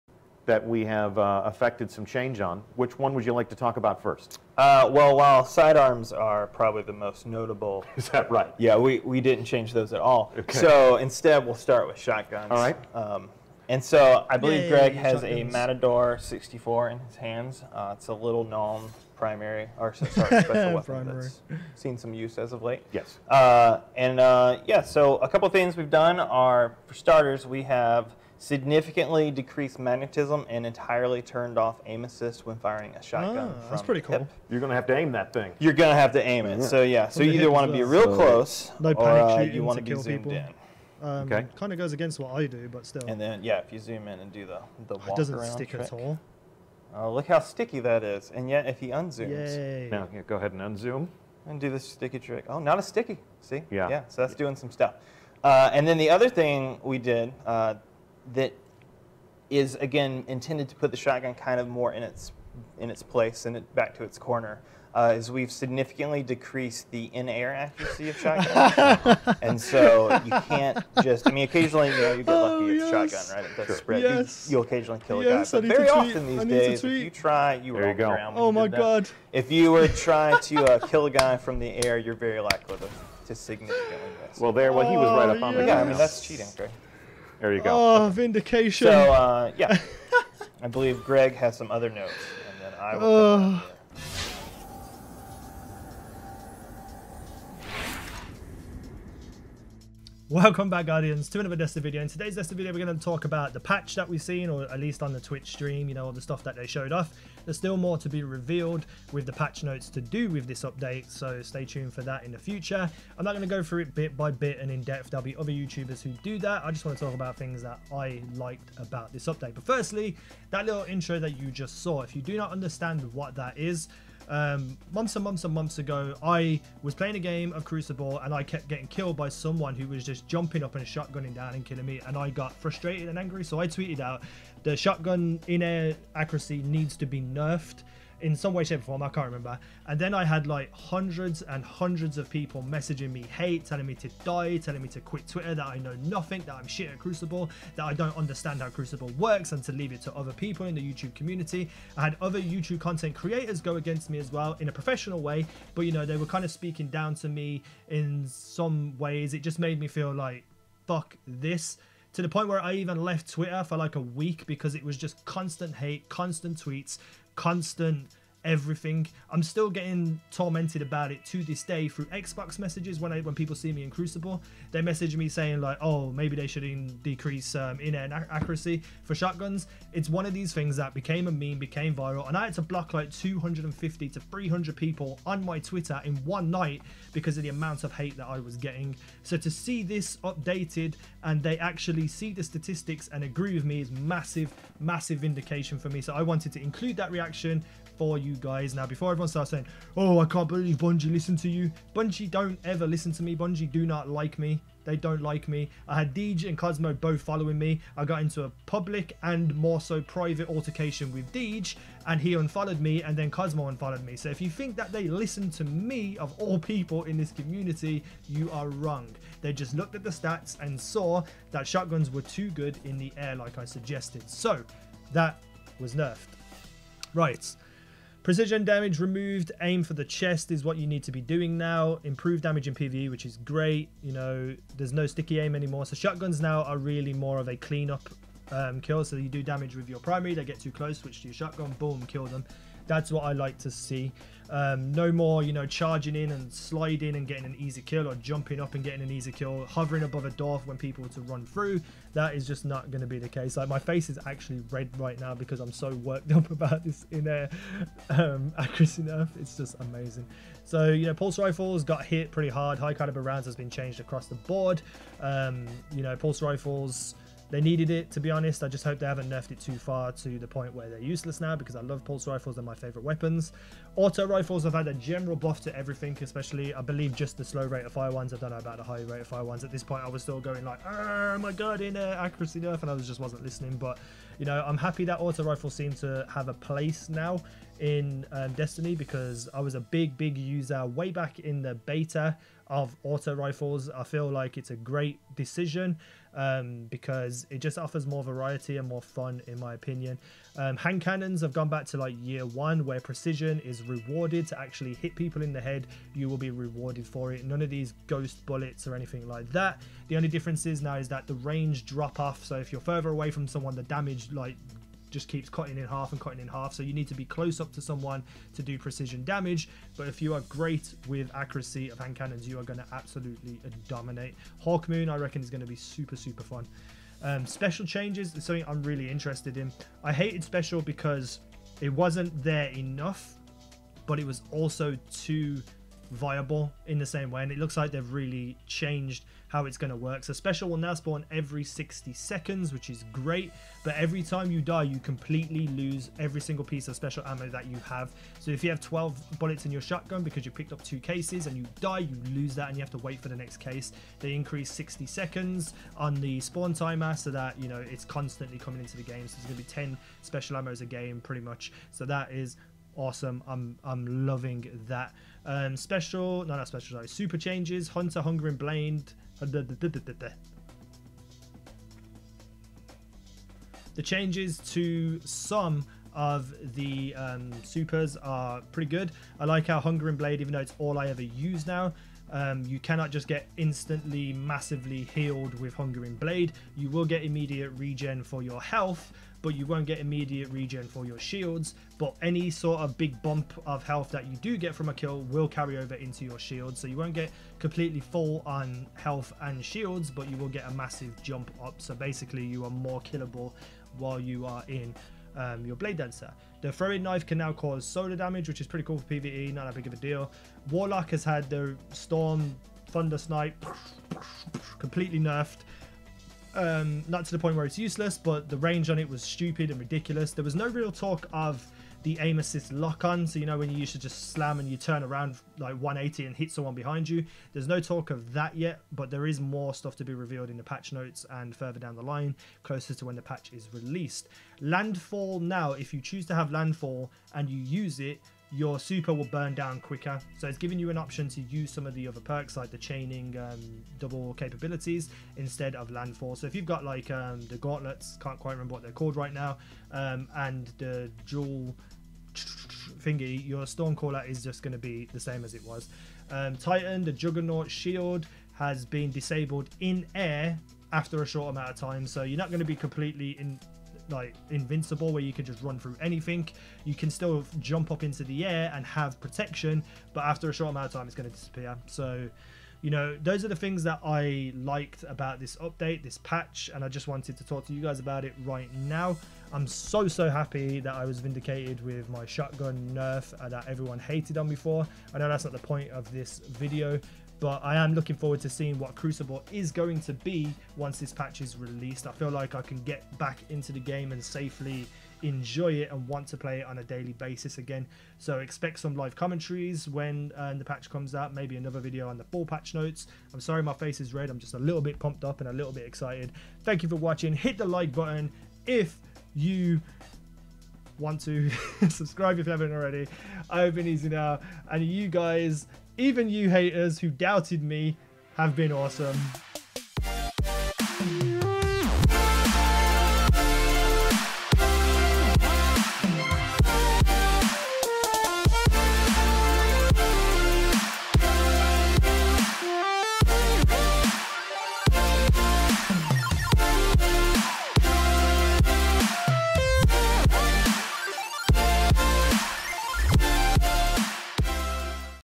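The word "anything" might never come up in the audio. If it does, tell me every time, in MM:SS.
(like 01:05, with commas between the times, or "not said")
05:08, 07:46.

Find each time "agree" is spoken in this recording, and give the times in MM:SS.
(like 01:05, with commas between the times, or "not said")
03:13.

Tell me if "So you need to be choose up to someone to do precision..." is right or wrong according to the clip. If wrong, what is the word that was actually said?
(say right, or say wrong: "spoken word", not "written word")
wrong: "close", not "choose".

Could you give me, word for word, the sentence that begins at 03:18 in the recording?
Now, before everyone starts saying, oh, I can't believe Bungie listened to you.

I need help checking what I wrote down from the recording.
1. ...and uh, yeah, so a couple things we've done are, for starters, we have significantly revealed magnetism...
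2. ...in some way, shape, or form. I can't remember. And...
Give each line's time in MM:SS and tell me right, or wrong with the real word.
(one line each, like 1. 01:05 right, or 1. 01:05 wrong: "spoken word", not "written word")
1. 00:23 wrong: "decreased", not "revealed"
2. 02:18 right.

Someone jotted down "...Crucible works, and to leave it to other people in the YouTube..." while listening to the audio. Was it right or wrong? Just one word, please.
right.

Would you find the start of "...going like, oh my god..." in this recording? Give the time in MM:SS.
04:40.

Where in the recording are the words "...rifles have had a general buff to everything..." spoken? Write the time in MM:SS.
04:34.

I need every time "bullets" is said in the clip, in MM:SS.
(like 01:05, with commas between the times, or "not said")
05:08, 05:49.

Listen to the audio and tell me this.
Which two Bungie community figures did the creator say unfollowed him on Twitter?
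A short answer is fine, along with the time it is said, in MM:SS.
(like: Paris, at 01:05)
Deej and Cosmo, at 03:26.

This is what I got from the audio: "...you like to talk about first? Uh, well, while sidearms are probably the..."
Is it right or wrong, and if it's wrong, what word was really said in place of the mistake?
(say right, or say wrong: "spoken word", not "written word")
right.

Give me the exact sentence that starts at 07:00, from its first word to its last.
There was no real talk of the aim assist lock on.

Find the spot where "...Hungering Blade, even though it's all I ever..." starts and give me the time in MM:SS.
06:19.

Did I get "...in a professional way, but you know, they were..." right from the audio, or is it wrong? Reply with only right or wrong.
right.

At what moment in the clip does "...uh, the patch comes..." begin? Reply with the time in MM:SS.
08:20.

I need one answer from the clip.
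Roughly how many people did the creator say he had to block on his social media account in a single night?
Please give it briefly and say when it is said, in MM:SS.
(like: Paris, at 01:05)
250 to 300, at 03:03.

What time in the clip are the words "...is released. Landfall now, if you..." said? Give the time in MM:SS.
07:13.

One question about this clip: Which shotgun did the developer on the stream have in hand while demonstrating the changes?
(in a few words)
Matador 64.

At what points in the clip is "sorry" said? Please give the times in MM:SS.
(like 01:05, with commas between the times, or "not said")
00:19, 06:06, 08:23.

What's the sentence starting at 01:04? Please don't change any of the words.
Uh, is we've significantly decreased the in-air accuracy of shotguns.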